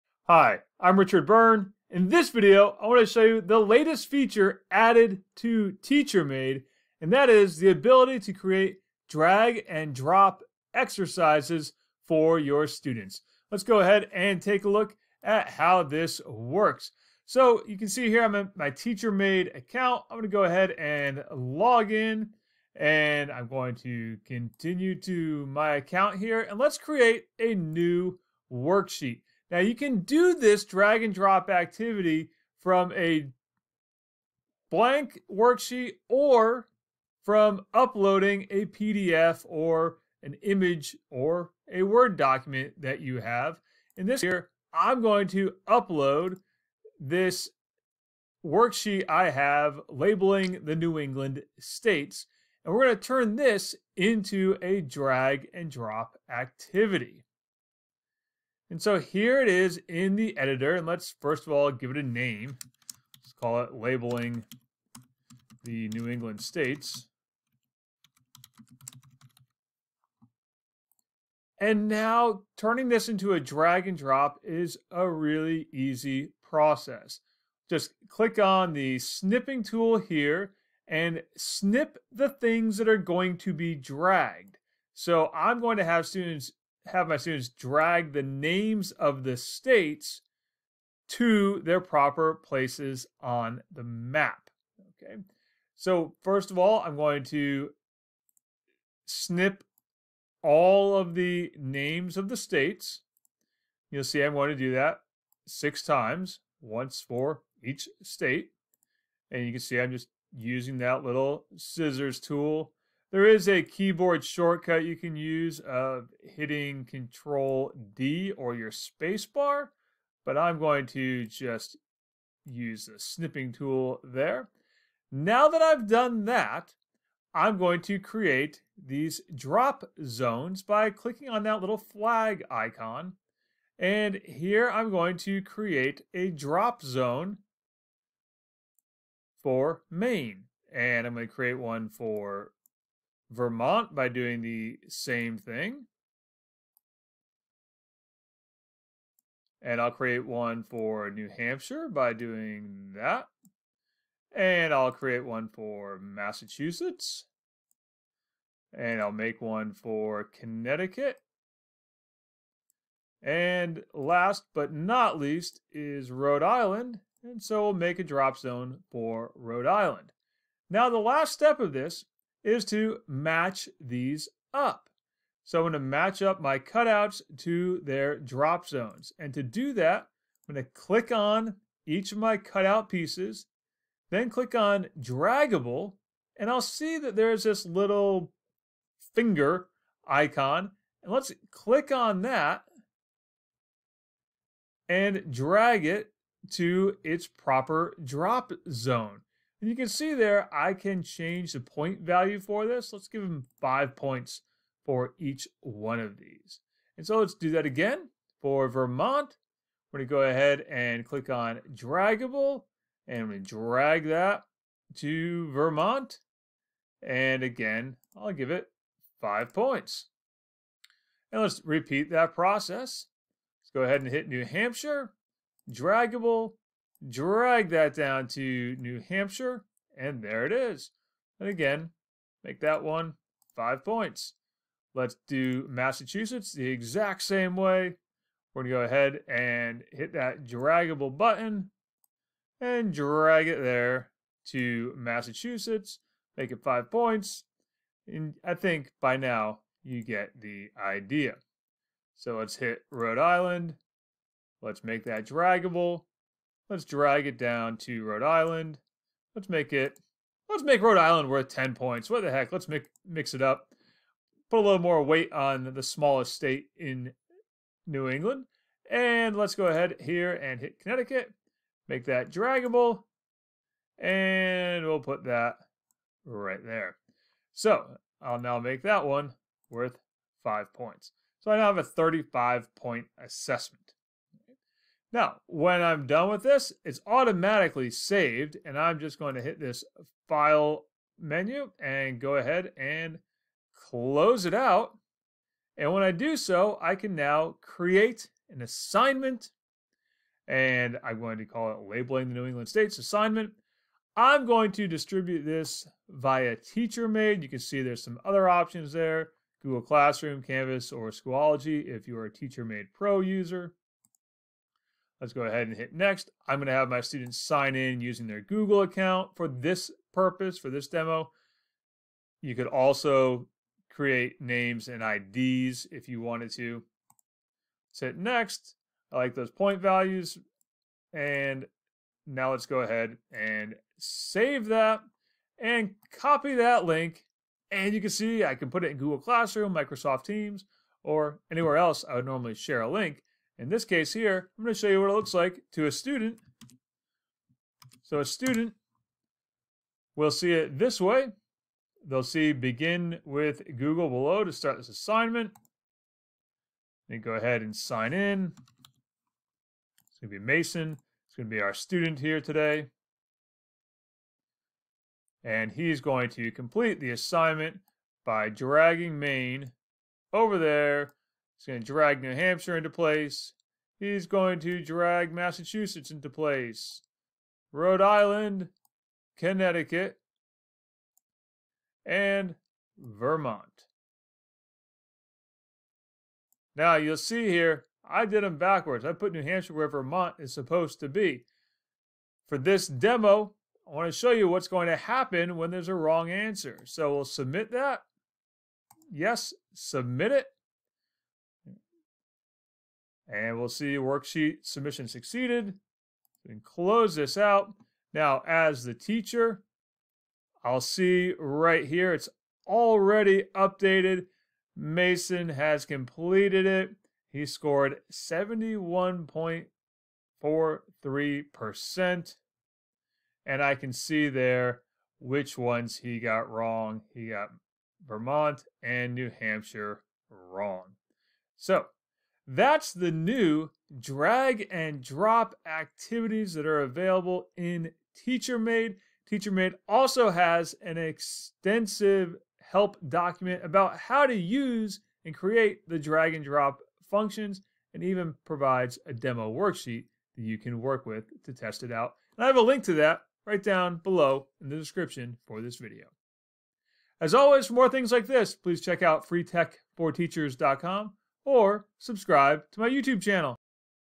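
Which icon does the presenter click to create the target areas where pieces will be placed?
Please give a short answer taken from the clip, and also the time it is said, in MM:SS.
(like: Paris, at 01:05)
flag icon, at 02:11.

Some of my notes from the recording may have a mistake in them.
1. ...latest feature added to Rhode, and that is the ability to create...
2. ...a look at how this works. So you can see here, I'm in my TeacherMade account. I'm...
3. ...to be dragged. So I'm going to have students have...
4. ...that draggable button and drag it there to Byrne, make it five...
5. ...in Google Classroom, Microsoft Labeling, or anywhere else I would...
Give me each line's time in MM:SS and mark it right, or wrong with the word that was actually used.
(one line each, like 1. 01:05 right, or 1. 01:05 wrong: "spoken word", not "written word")
1. 00:03 wrong: "TeacherMade", not "Rhode"
2. 00:14 right
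3. 01:23 right
4. 04:00 wrong: "Massachusetts", not "Byrne"
5. 05:38 wrong: "Teams", not "Labeling".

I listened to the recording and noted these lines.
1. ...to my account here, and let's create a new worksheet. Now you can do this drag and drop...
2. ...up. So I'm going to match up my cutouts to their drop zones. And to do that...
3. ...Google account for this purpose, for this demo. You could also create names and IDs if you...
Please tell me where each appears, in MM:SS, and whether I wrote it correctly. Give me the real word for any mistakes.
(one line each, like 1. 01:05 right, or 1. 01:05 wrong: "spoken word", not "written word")
1. 00:25 right
2. 02:54 right
3. 05:18 right.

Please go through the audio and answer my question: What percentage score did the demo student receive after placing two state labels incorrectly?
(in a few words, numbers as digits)
71.43%.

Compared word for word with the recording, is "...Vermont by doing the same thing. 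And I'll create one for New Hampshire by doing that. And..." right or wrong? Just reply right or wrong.
right.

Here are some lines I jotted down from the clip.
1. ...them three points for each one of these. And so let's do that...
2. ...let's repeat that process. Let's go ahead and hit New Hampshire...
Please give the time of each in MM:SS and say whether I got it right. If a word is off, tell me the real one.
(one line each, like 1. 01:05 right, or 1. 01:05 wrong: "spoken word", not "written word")
1. 03:23 wrong: "five", not "three"
2. 03:41 right.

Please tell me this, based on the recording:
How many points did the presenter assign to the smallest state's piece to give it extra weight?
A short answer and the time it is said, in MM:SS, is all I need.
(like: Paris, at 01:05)
10, at 04:21.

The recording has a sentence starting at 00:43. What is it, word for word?
In this here, I'm going to upload this worksheet I have labeling the New England states.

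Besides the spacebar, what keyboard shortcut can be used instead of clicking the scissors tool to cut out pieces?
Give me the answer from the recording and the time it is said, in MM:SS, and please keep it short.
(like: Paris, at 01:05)
Control D, at 01:56.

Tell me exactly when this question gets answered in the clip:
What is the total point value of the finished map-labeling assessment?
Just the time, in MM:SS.
04:41.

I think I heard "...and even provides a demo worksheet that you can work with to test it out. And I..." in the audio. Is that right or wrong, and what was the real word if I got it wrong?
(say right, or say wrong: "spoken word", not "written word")
right.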